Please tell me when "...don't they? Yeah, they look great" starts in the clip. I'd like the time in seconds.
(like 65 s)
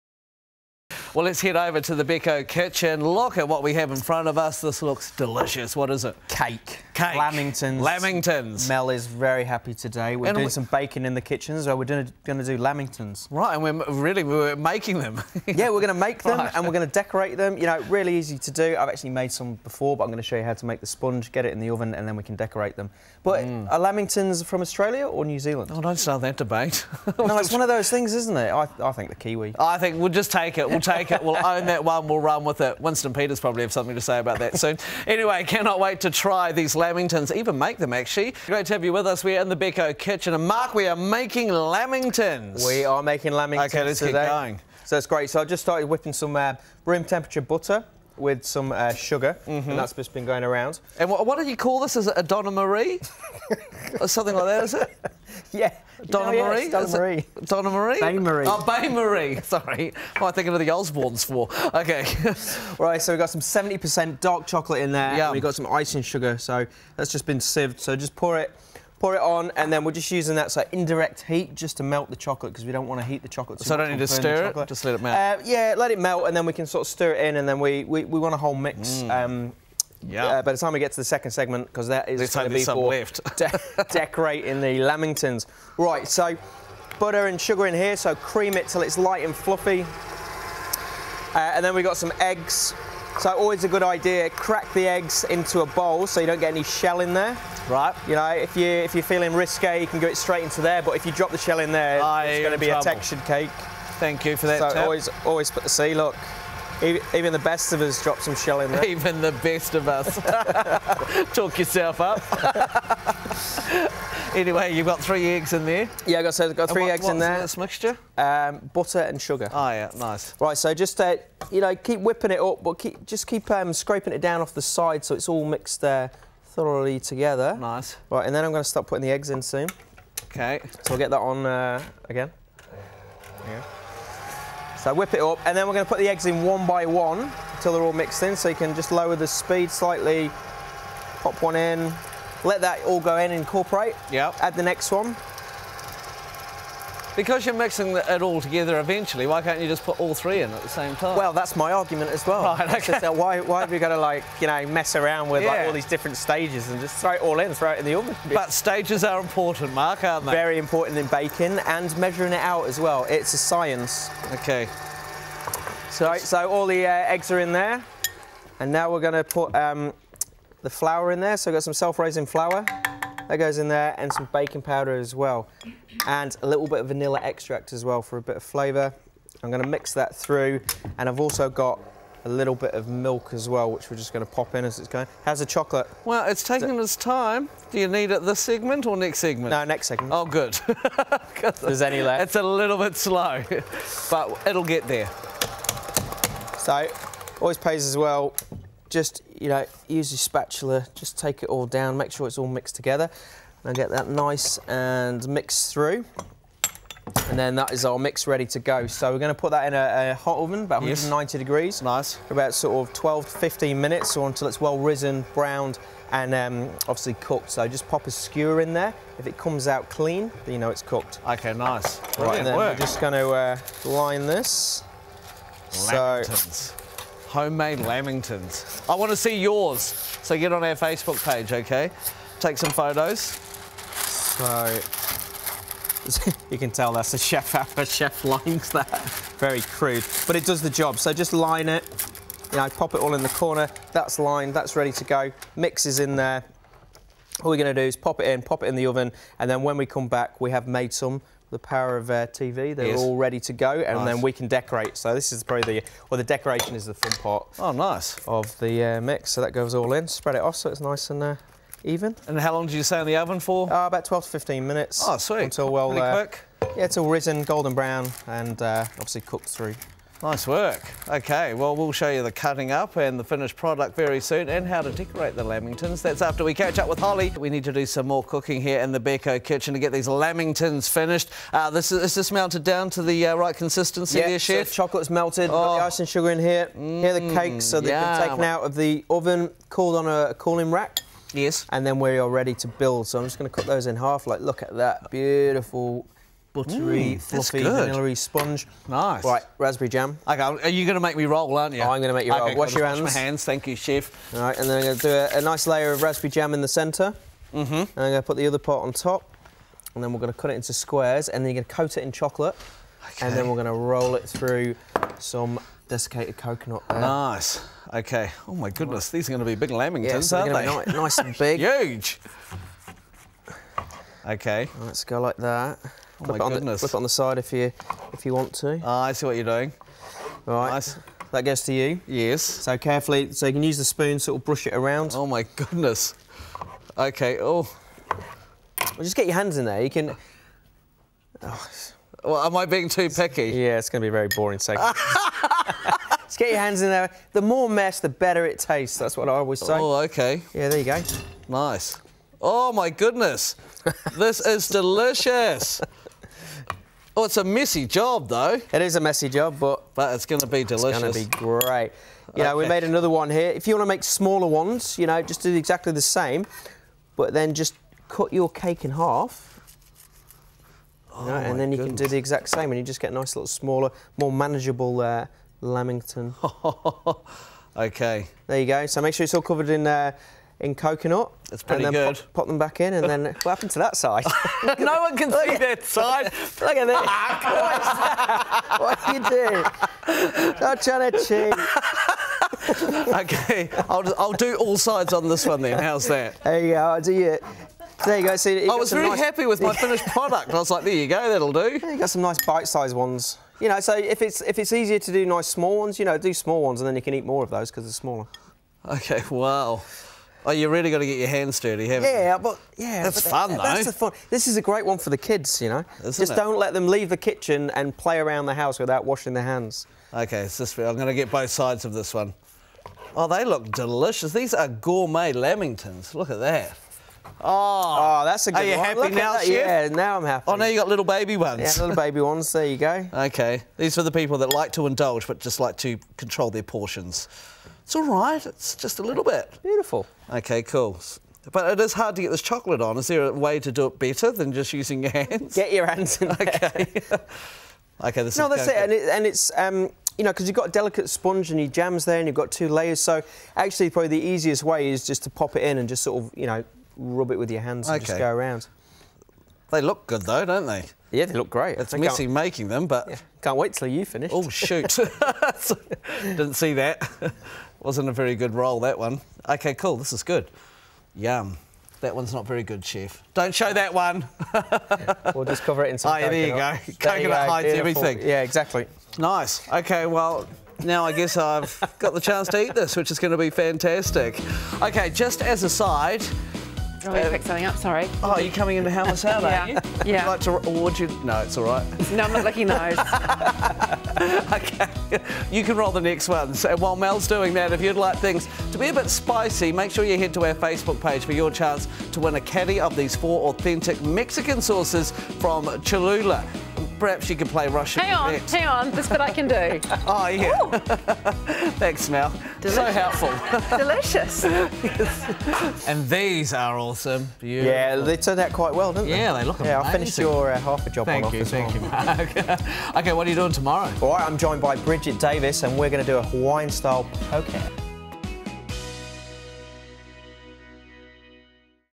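460 s.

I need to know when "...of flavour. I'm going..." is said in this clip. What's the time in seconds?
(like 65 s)
178 s.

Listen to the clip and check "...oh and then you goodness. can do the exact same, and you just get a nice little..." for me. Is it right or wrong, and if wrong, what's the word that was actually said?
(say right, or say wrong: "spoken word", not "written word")
right.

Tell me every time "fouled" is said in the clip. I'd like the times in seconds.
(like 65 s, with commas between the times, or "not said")
not said.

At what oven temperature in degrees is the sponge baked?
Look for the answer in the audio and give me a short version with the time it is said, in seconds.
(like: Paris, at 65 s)
190, at 211 s.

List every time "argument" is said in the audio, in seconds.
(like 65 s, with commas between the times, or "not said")
151 s.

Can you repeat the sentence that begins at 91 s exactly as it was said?
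Uh, and then we've got some eggs.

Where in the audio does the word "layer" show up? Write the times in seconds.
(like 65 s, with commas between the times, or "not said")
305 s, 452 s.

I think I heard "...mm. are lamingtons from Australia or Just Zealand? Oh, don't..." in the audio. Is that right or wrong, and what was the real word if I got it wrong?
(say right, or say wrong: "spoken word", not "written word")
wrong: "New", not "Just".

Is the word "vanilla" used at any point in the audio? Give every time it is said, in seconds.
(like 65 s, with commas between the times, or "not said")
176 s, 297 s.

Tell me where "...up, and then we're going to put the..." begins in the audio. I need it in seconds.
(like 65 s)
135 s.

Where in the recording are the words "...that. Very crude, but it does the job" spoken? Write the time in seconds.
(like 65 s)
238 s.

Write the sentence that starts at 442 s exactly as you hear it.
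Is there a way to do it better than just using your hands?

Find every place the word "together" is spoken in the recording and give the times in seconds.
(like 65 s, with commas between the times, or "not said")
126 s, 148 s, 202 s.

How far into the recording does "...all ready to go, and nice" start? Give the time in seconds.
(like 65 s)
252 s.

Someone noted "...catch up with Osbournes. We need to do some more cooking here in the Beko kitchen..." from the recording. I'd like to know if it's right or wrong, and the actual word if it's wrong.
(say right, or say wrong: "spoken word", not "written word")
wrong: "Holly", not "Osbournes".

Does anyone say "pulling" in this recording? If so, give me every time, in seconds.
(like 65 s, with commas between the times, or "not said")
not said.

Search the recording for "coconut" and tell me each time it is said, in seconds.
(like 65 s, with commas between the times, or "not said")
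316 s, 380 s, 476 s.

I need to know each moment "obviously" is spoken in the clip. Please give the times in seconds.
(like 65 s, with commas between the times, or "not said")
216 s, 268 s.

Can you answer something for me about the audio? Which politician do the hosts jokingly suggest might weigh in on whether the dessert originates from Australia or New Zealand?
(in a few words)
Winston Peters.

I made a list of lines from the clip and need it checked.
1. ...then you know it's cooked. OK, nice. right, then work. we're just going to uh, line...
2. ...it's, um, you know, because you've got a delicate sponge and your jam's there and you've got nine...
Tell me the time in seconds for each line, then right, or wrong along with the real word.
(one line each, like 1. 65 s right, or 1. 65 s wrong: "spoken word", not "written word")
1. 220 s right
2. 449 s wrong: "two", not "nine".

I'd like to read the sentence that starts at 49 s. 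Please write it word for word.
and that's just been going around.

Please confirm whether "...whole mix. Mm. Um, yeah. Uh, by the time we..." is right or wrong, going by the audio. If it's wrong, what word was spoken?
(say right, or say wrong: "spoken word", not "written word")
right.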